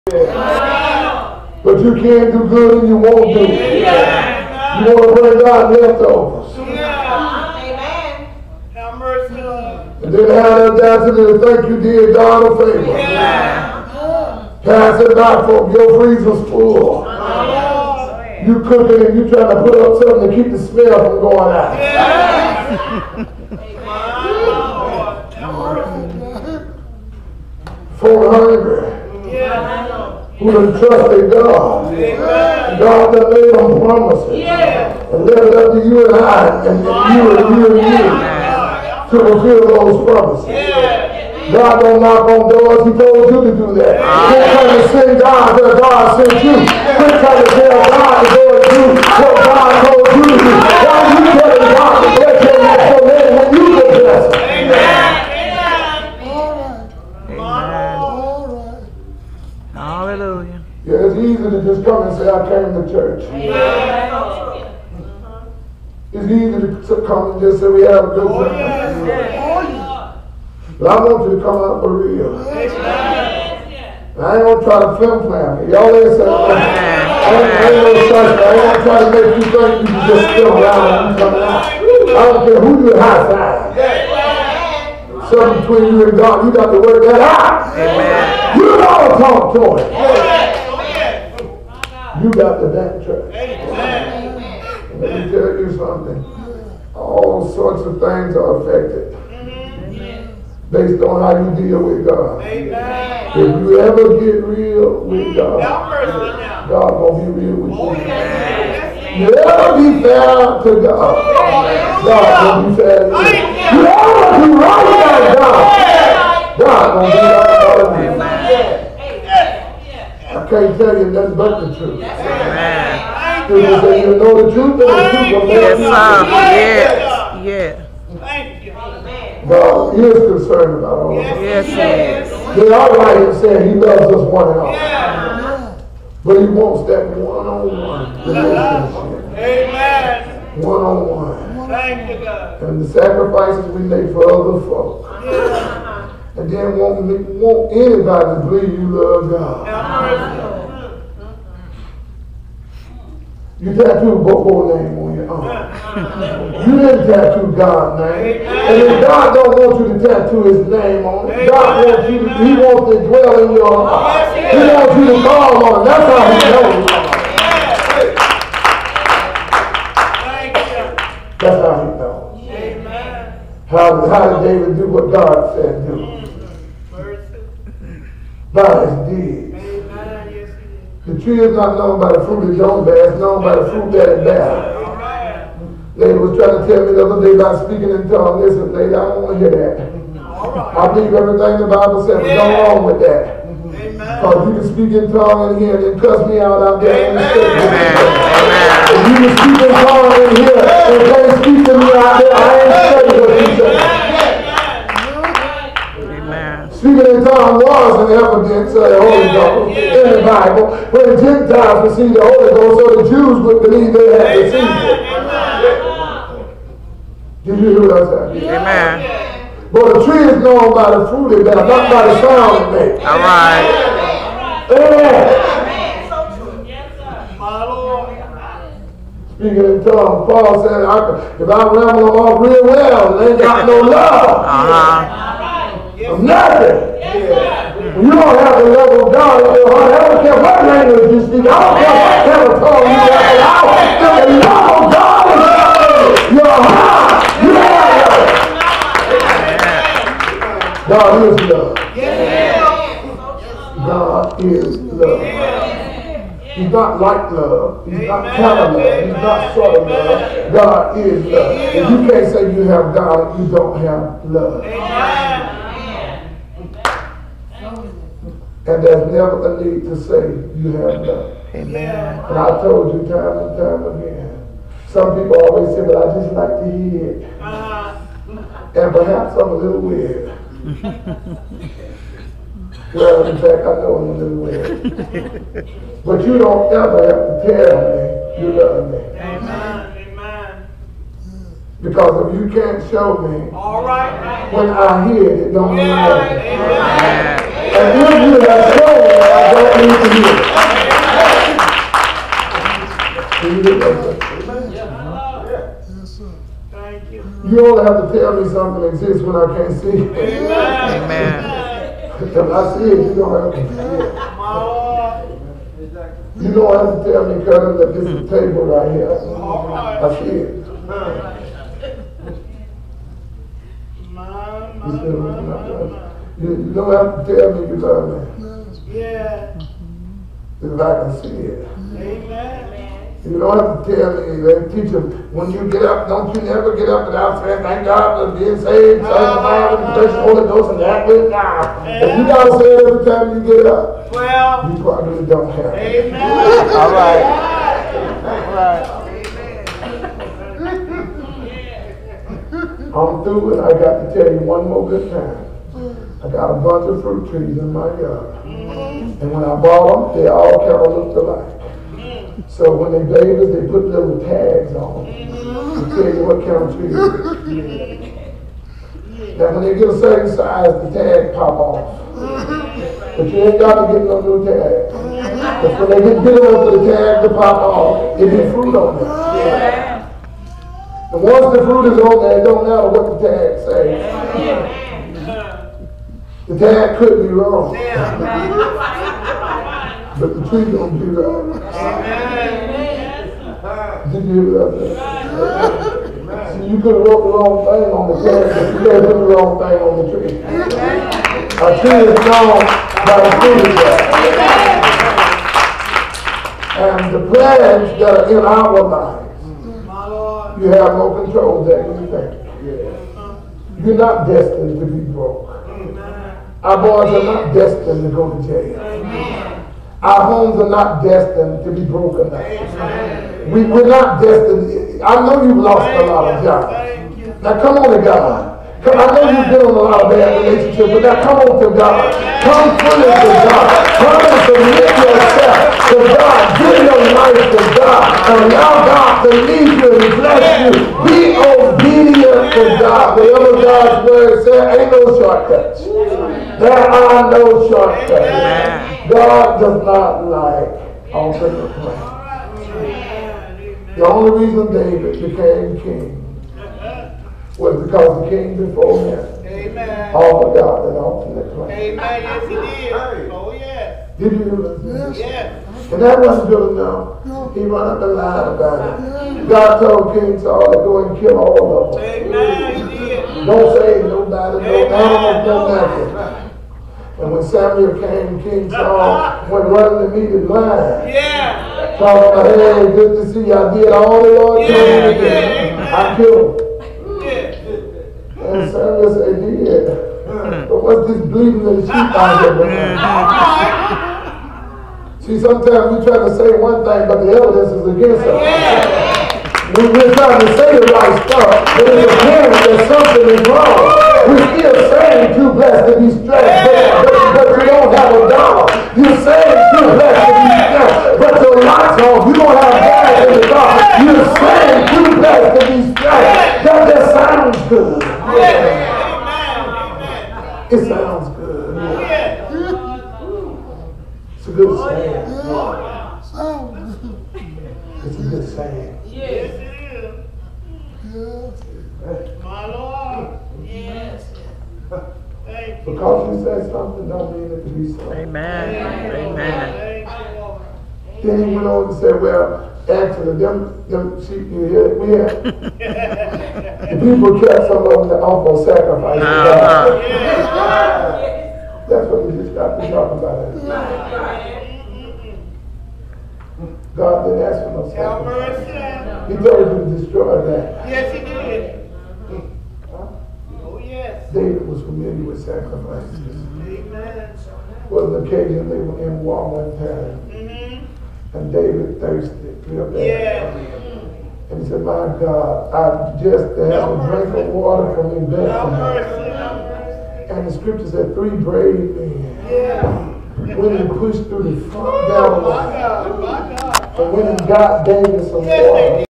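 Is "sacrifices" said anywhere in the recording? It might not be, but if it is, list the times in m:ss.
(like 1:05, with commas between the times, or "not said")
2:22, 9:08, 9:17, 9:25.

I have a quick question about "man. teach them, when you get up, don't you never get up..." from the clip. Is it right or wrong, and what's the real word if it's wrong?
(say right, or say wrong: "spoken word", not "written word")
right.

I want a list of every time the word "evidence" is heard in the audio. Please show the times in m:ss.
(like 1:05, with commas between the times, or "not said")
3:28, 8:17.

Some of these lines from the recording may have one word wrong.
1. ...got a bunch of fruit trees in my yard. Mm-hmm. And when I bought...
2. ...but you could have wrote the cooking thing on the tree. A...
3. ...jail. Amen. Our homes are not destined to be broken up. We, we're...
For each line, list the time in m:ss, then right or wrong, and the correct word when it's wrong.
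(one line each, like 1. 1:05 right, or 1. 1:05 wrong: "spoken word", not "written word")
1. 5:56 right
2. 6:38 wrong: "wrong", not "cooking"
3. 6:58 right.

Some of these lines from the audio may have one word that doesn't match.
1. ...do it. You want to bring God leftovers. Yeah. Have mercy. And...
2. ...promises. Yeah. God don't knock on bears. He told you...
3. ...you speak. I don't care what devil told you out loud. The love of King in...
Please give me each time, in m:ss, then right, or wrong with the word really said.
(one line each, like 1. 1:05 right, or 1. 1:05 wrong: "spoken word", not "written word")
1. 0:03 right
2. 0:40 wrong: "doors", not "bears"
3. 4:01 wrong: "God", not "King".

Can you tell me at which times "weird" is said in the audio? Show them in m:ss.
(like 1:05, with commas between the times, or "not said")
4:39, 4:44.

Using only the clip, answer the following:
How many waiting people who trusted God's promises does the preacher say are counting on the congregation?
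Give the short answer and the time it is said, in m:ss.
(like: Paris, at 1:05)
400, at 0:27.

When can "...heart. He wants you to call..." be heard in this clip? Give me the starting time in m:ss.
2:43.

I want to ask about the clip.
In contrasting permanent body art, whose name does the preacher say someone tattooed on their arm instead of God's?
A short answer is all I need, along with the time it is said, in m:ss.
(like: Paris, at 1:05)
Bobo, at 2:34.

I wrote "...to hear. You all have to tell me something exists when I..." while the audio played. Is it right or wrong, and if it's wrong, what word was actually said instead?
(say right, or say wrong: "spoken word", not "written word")
right.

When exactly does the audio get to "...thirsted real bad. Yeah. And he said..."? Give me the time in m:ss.
9:32.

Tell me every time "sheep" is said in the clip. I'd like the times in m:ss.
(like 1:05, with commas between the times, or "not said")
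8:11, 9:04.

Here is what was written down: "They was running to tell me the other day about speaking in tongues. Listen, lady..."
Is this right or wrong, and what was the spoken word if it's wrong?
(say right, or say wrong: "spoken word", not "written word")
wrong: "trying", not "running".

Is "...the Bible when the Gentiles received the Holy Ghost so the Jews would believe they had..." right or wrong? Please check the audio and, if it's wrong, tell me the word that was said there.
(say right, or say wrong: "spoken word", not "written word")
right.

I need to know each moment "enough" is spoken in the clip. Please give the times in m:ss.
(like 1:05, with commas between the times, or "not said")
6:16, 7:46.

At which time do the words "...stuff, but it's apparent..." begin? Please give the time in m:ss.
8:21.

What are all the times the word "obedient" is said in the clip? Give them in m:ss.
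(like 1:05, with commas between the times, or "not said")
7:21.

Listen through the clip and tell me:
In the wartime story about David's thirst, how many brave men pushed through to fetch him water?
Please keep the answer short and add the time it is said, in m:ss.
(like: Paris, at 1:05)
3, at 9:41.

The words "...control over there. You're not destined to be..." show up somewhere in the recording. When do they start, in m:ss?
6:51.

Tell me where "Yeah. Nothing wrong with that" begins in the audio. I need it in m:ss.
3:12.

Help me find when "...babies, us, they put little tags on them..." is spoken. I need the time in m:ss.
6:03.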